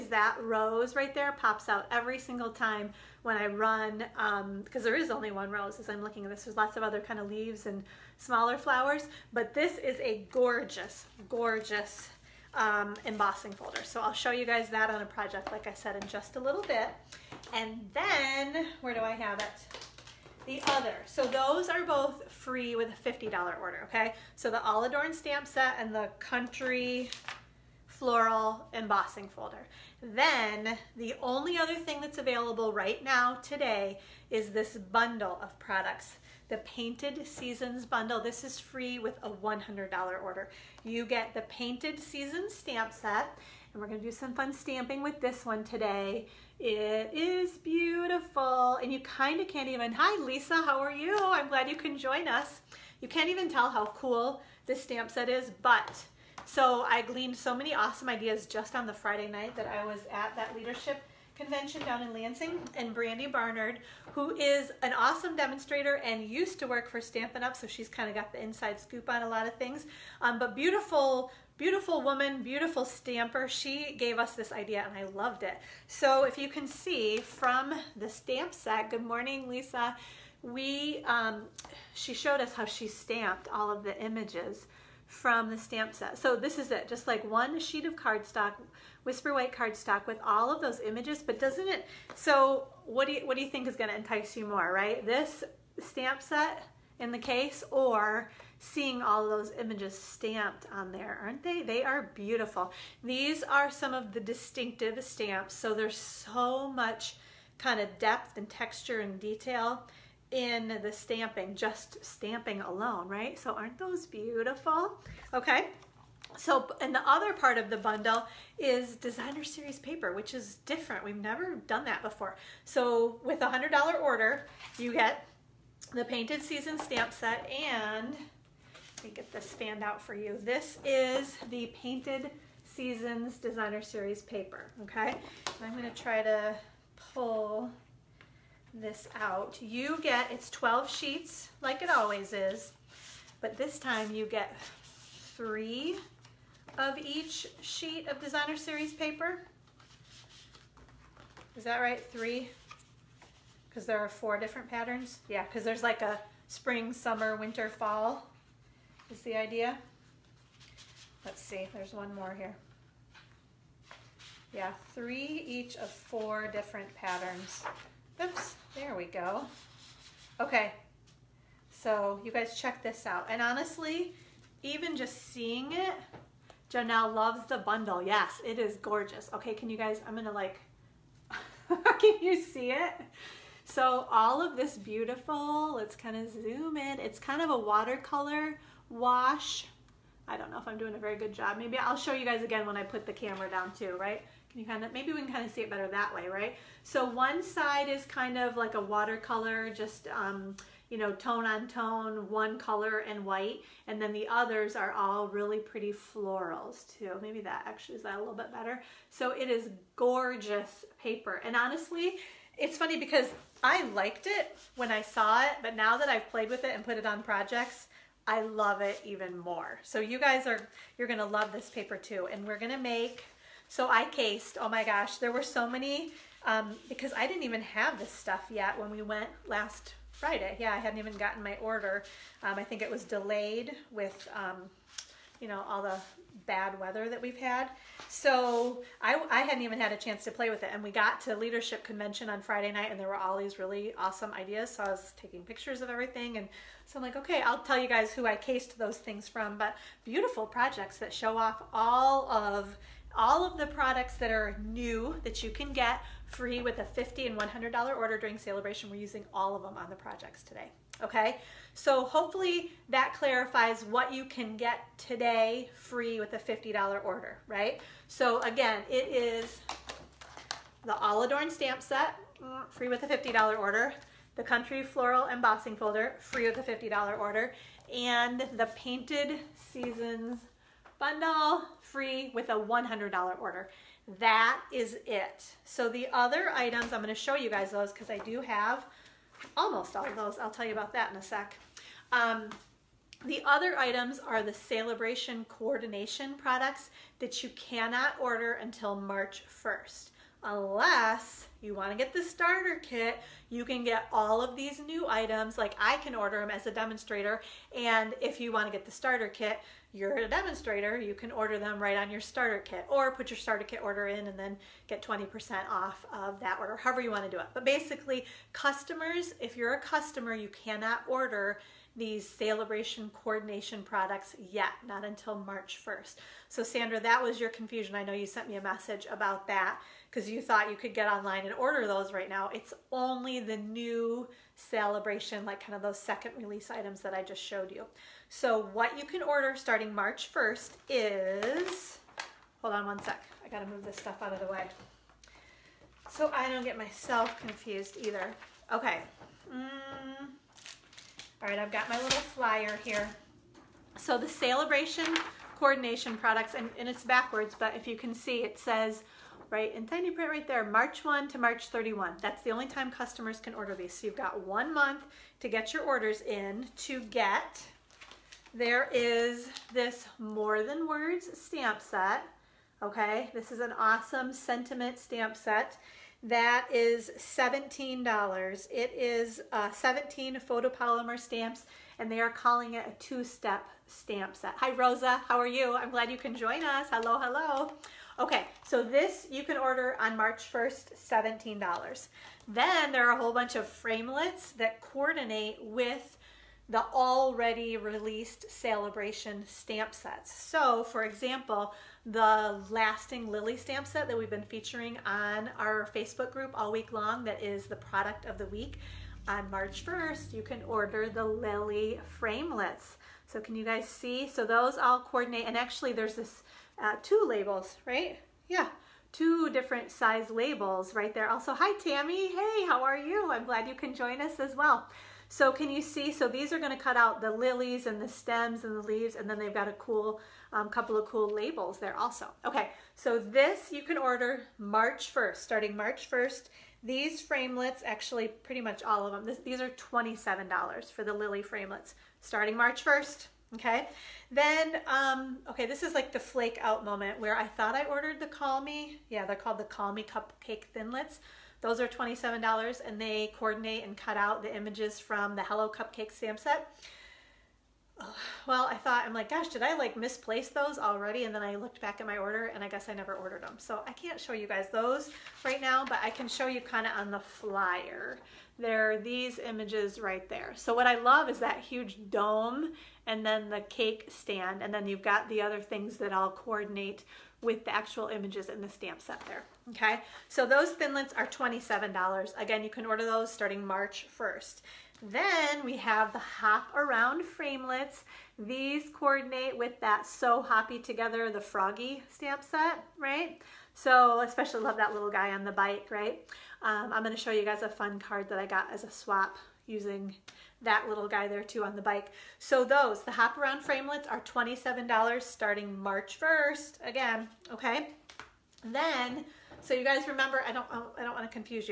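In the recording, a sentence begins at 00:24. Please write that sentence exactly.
So the All Adorned stamp set and the Country floral embossing folder.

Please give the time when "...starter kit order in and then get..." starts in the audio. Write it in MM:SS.
05:13.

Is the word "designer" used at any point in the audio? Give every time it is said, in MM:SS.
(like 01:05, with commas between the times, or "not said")
01:58, 02:13, 02:28.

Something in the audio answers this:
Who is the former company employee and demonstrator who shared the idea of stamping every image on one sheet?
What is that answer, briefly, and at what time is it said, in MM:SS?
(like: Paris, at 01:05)
Brandy Barnard, at 01:02.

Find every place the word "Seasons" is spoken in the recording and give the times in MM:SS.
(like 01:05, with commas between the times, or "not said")
00:37, 00:41, 02:06, 02:12, 04:39.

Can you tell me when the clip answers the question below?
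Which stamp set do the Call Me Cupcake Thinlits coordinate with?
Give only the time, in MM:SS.
07:35.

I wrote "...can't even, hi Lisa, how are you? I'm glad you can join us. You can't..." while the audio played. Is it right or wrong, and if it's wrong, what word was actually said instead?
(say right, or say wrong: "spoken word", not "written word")
right.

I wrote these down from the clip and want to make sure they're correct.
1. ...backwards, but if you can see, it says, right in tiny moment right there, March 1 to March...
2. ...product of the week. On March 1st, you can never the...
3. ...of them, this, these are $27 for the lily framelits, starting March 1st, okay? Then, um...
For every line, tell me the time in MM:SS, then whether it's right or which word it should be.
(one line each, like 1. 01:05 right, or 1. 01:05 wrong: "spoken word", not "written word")
1. 05:57 wrong: "print", not "moment"
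2. 06:47 wrong: "order", not "never"
3. 07:19 right.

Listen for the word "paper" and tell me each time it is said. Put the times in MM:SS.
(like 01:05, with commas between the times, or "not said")
01:59, 02:14, 02:28, 03:31, 03:41.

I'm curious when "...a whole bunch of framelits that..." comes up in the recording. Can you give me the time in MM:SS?
06:33.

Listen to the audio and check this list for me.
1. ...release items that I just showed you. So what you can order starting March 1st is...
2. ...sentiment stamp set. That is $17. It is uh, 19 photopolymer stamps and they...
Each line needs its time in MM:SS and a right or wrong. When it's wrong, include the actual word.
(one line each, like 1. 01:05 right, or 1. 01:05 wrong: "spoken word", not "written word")
1. 05:36 right
2. 06:14 wrong: "17", not "19".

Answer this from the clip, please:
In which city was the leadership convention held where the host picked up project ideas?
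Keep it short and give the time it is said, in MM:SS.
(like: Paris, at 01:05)
Lansing, at 01:02.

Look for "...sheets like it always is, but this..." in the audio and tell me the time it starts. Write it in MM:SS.
02:20.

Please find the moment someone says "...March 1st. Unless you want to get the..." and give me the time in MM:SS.
04:58.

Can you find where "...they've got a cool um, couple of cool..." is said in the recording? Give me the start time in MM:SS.
07:09.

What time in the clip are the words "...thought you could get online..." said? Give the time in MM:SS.
05:30.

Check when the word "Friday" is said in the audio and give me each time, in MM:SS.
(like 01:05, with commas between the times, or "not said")
00:58, 03:50, 04:02.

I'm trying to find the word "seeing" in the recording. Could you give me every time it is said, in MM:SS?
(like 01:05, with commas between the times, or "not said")
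01:38, 02:55.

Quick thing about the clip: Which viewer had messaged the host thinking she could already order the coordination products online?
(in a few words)
Sandra.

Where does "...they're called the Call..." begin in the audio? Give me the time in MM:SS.
07:29.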